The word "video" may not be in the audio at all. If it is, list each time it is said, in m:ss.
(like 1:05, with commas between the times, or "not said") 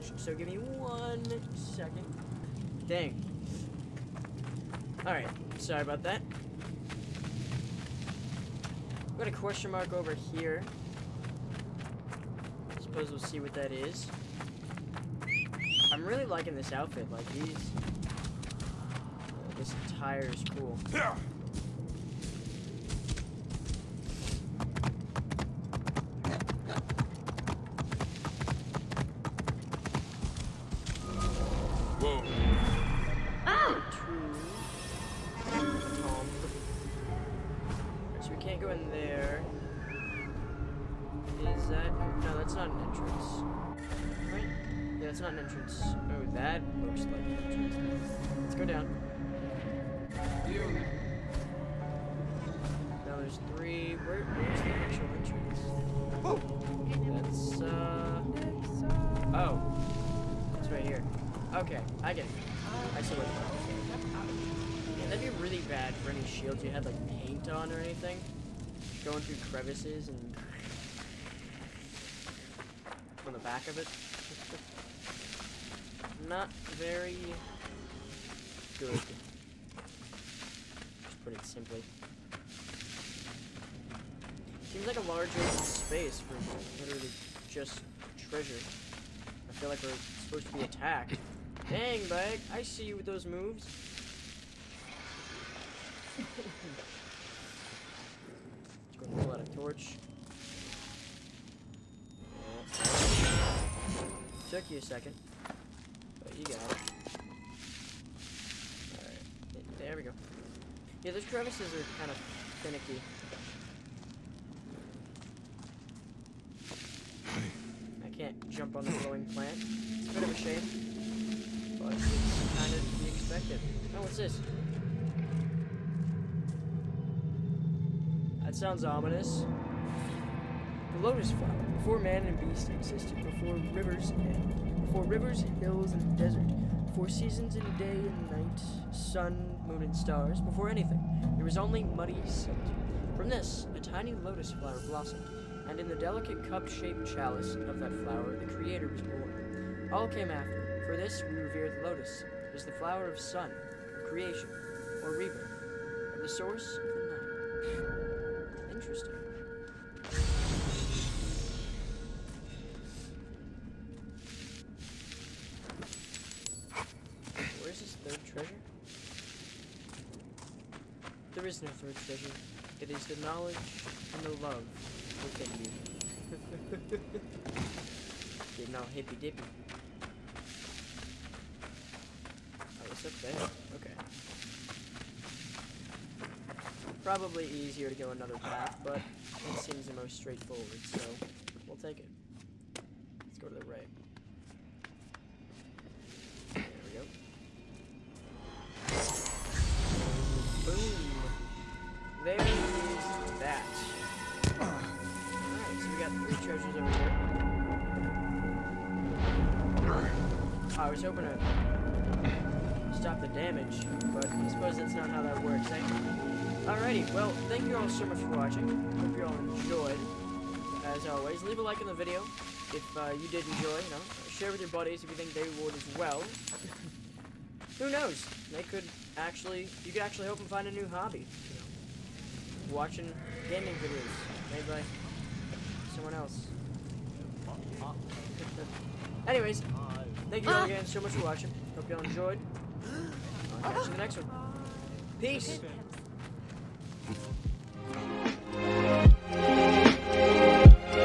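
3:41, 3:53.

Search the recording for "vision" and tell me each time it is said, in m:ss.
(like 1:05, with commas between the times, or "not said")
not said.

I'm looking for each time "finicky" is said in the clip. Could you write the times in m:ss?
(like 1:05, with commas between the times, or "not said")
1:52.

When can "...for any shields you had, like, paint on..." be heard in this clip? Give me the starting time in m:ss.
1:05.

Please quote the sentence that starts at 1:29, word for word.
I feel like we're supposed to be attacked.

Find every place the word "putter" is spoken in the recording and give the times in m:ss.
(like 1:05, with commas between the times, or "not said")
not said.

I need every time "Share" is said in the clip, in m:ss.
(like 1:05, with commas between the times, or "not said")
3:44.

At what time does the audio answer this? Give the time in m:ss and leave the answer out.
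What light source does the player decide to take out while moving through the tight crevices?
1:39.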